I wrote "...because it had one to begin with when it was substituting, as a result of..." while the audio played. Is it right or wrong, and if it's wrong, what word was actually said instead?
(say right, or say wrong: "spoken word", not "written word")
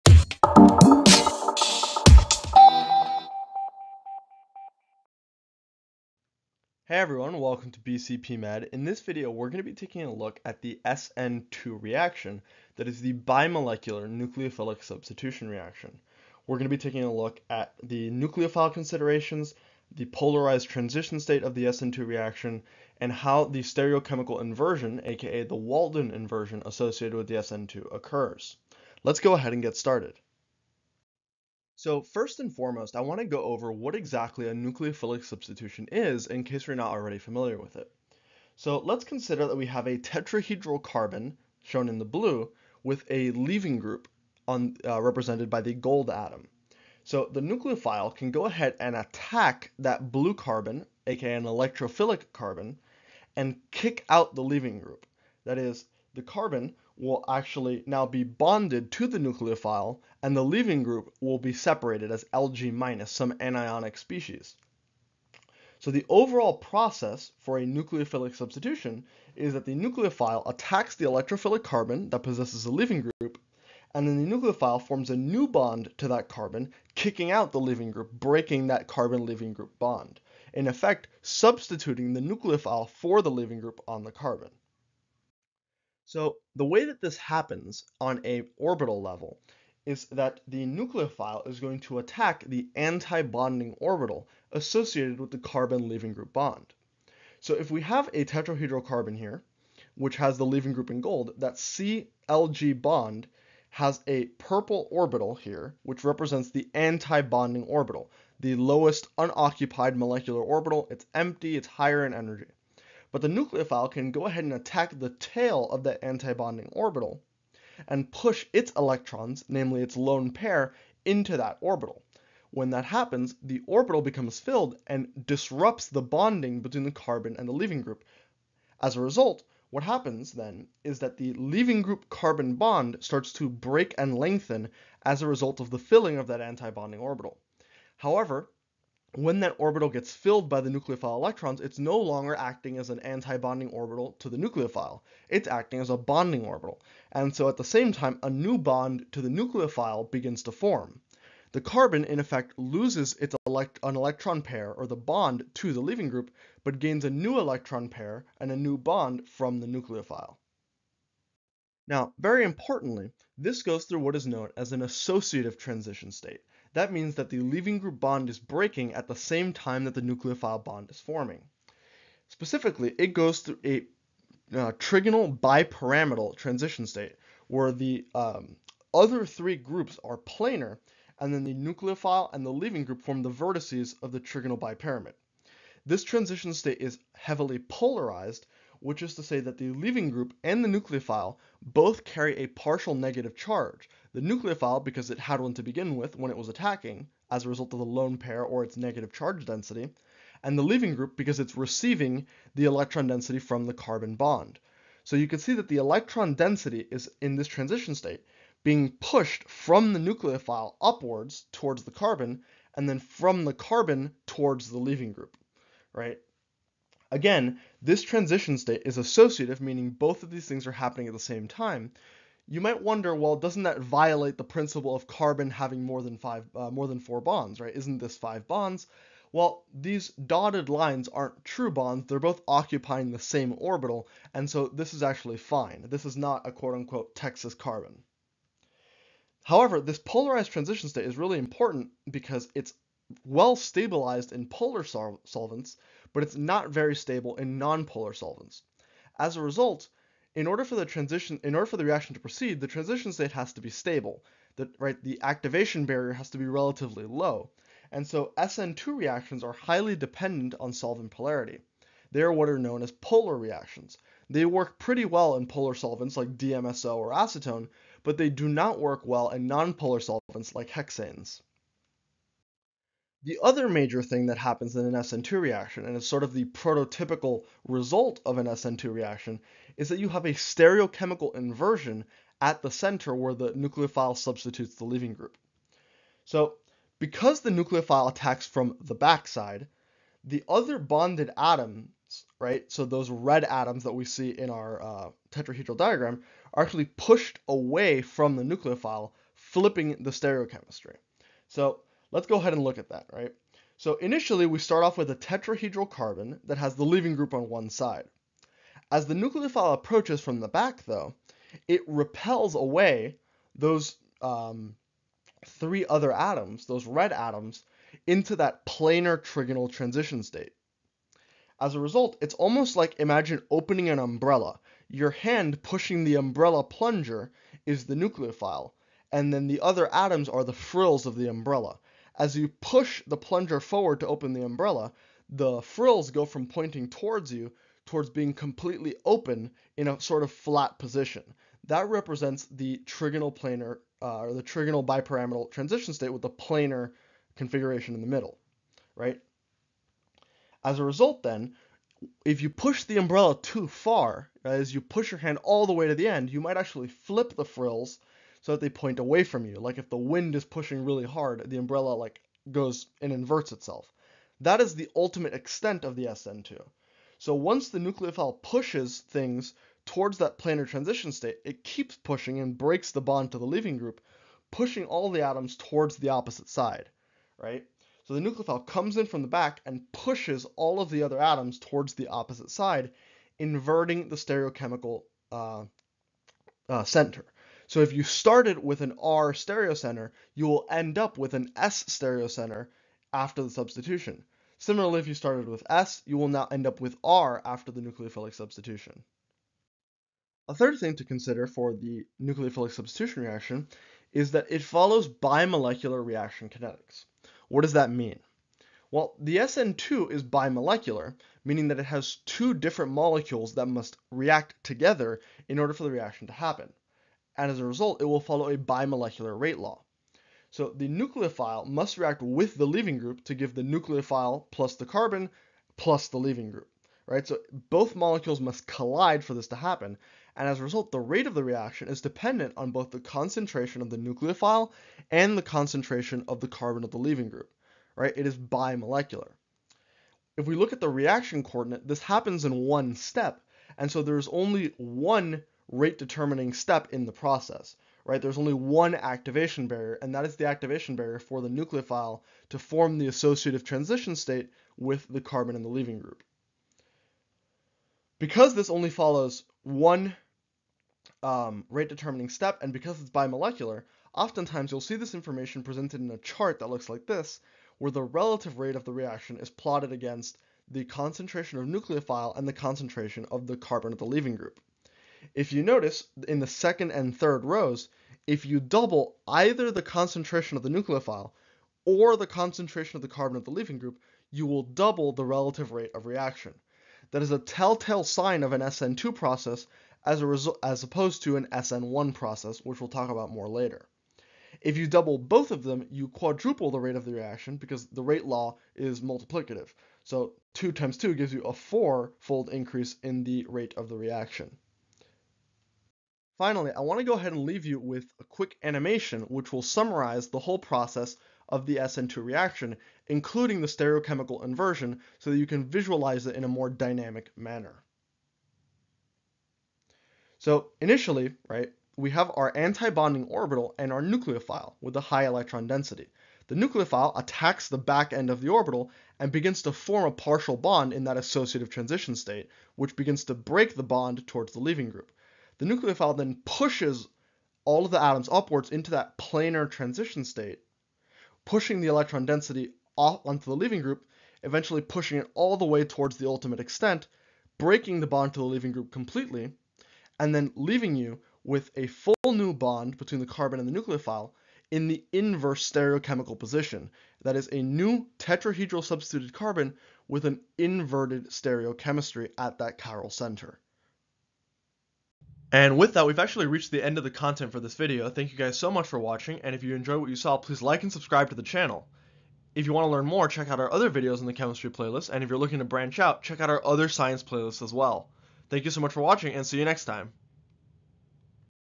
wrong: "attacking", not "substituting".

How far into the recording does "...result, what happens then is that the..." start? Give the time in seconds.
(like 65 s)
129 s.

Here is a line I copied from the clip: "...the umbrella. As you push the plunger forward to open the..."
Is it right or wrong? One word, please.
right.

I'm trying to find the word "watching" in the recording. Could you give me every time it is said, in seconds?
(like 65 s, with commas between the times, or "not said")
568 s, 579 s.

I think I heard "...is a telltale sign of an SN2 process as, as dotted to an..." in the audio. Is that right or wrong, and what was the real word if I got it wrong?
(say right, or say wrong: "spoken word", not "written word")
wrong: "opposed", not "dotted".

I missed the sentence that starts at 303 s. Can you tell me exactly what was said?
So initially, we start off with a tetrahedral carbon that has the leaving group on one side.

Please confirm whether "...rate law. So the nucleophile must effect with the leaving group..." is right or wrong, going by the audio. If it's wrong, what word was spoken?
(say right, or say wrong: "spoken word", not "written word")
wrong: "react", not "effect".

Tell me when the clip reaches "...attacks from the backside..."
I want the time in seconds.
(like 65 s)
288 s.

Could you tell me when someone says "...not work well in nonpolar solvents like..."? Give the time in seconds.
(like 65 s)
268 s.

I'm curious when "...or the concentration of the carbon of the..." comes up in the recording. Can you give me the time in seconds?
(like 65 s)
481 s.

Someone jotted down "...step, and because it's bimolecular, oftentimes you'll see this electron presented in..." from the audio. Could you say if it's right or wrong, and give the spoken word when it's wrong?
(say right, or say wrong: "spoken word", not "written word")
wrong: "information", not "electron".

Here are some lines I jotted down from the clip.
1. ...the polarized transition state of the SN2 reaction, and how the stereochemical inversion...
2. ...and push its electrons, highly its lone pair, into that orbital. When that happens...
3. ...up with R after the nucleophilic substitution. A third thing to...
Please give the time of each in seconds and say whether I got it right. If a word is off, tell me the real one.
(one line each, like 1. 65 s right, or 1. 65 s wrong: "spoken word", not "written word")
1. 19 s right
2. 117 s wrong: "namely", not "highly"
3. 396 s right.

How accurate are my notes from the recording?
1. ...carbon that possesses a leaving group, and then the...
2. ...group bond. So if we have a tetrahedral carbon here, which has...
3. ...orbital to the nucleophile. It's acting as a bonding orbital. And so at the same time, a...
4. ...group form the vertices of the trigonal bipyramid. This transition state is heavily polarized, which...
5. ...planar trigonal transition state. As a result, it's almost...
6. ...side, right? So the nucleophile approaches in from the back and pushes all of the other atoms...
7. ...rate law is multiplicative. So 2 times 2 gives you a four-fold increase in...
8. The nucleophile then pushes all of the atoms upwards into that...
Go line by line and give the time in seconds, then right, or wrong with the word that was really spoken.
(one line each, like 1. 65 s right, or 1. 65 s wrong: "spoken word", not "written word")
1. 71 s right
2. 96 s right
3. 143 s right
4. 182 s right
5. 318 s right
6. 376 s wrong: "comes", not "approaches"
7. 498 s right
8. 535 s right.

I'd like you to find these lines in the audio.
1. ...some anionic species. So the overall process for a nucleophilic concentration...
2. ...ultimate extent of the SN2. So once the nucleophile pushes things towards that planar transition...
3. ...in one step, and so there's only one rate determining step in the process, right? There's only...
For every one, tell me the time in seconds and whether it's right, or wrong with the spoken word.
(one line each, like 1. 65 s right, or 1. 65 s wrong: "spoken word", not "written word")
1. 63 s wrong: "substitution", not "concentration"
2. 364 s right
3. 442 s right.